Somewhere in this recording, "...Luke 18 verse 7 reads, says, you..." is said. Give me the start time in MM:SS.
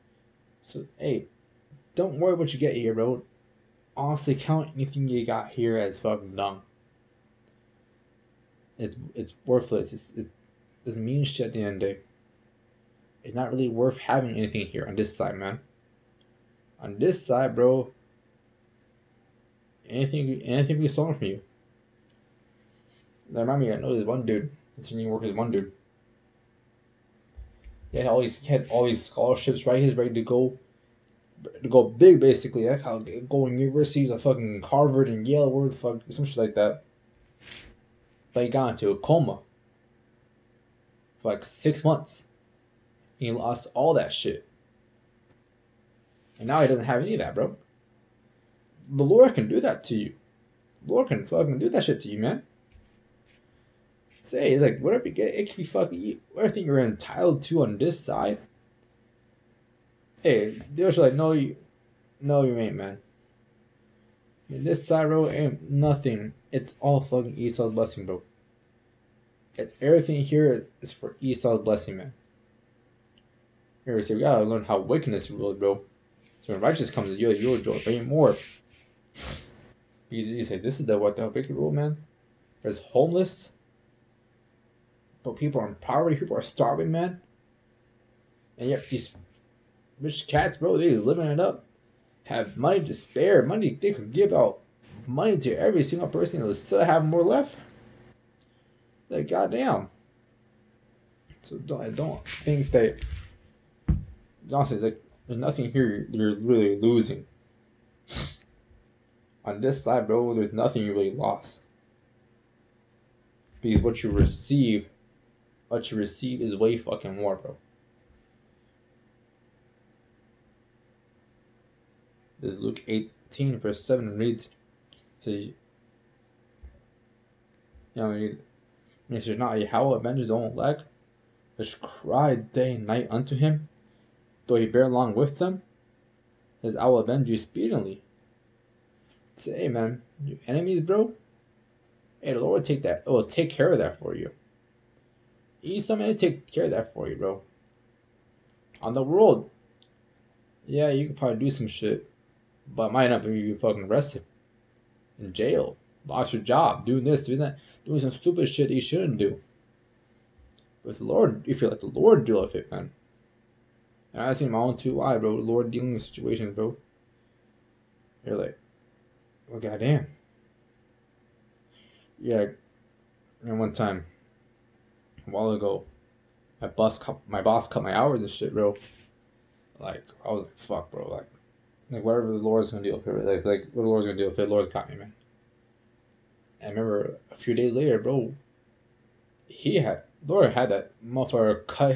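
02:02.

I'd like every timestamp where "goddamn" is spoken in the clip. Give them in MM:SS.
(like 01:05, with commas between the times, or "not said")
01:39, 02:49.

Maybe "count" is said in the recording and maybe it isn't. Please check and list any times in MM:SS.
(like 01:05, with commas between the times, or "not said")
00:04.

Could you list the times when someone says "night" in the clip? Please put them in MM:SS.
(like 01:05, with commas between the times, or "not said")
02:12.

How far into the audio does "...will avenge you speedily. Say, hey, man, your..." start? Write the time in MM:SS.
02:16.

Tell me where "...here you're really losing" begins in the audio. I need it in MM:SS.
01:45.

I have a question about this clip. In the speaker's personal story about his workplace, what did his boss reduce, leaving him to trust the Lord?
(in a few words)
hours.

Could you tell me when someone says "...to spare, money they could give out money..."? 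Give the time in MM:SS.
01:32.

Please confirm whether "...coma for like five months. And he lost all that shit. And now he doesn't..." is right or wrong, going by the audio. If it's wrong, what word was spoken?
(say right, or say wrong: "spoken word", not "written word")
wrong: "six", not "five".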